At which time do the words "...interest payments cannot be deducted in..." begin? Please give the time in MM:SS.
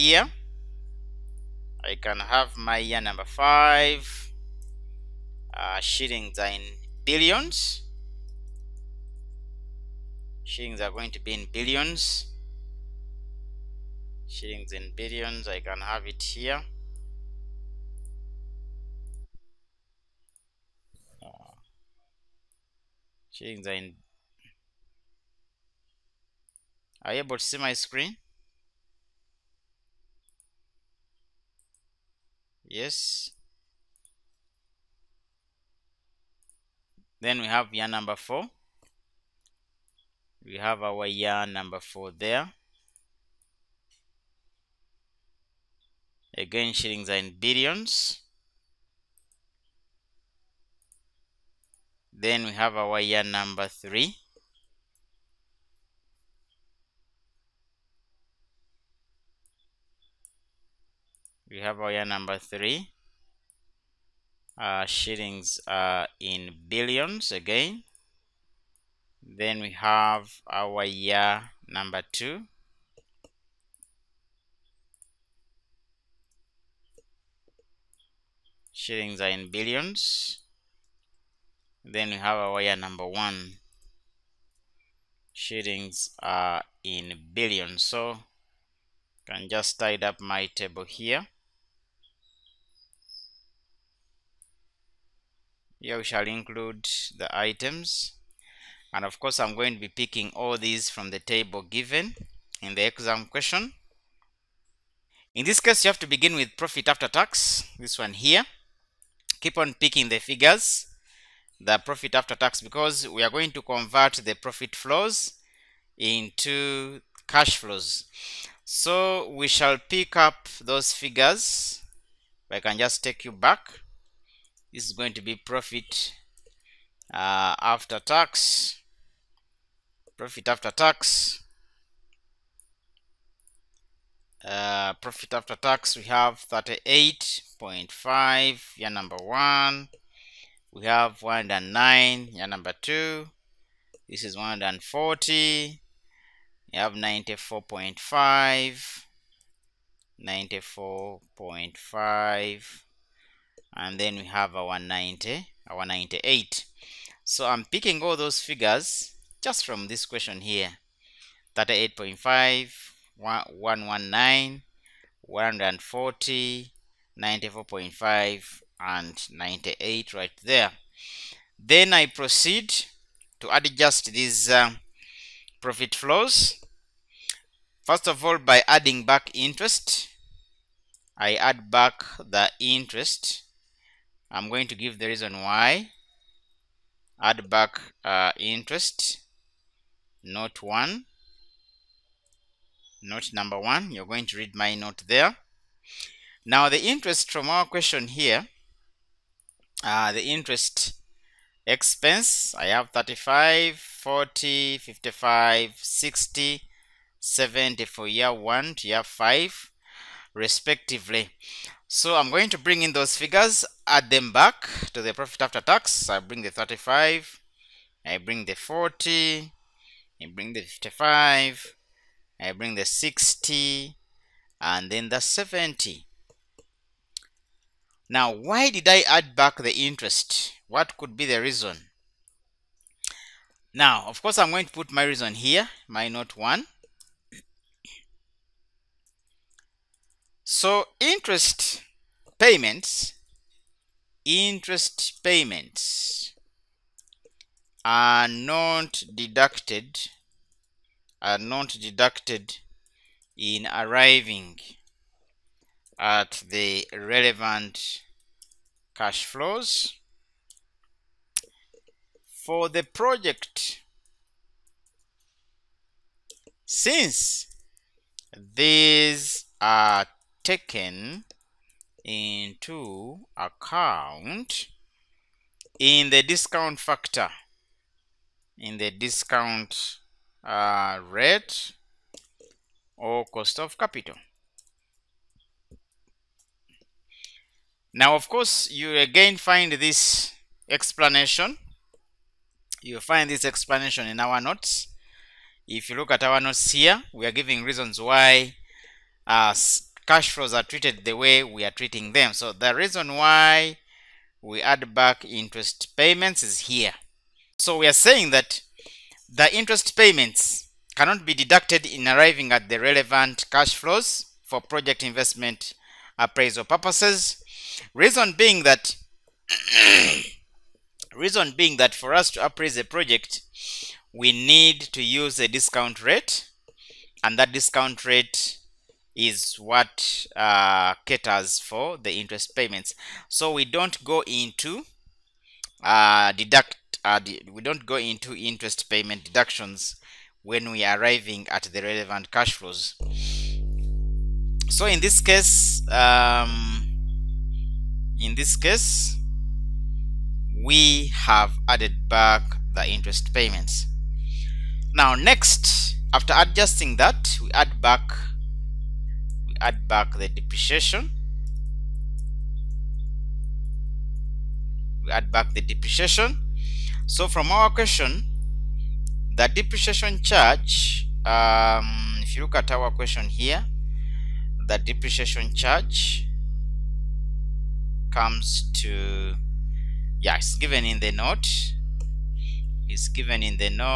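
05:09.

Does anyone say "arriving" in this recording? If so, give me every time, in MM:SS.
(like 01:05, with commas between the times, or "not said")
04:13, 05:12, 05:40.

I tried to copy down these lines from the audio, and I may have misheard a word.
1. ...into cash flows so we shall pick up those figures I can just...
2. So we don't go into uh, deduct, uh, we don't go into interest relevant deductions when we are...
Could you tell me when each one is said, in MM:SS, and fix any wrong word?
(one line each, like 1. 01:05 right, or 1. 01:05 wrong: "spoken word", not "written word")
1. 01:55 right
2. 05:33 wrong: "payment", not "relevant".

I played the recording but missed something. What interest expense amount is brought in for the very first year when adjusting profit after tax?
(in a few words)
35.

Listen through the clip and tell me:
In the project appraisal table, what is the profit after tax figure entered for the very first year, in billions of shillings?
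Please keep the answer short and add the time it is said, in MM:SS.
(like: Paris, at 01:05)
38.5, at 02:16.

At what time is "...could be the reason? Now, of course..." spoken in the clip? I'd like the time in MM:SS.
03:50.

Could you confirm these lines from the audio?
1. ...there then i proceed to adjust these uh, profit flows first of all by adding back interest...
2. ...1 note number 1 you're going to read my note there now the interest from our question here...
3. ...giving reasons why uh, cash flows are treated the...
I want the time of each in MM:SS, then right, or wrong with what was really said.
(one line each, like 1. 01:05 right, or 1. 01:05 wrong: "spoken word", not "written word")
1. 02:50 right
2. 03:10 right
3. 04:57 right.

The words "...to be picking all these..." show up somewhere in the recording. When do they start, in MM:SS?
01:39.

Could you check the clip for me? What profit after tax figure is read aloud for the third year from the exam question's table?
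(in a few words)
140.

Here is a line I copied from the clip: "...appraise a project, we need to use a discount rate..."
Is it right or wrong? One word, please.
right.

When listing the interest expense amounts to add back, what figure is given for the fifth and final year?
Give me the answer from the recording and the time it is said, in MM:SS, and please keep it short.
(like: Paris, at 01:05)
70, at 03:27.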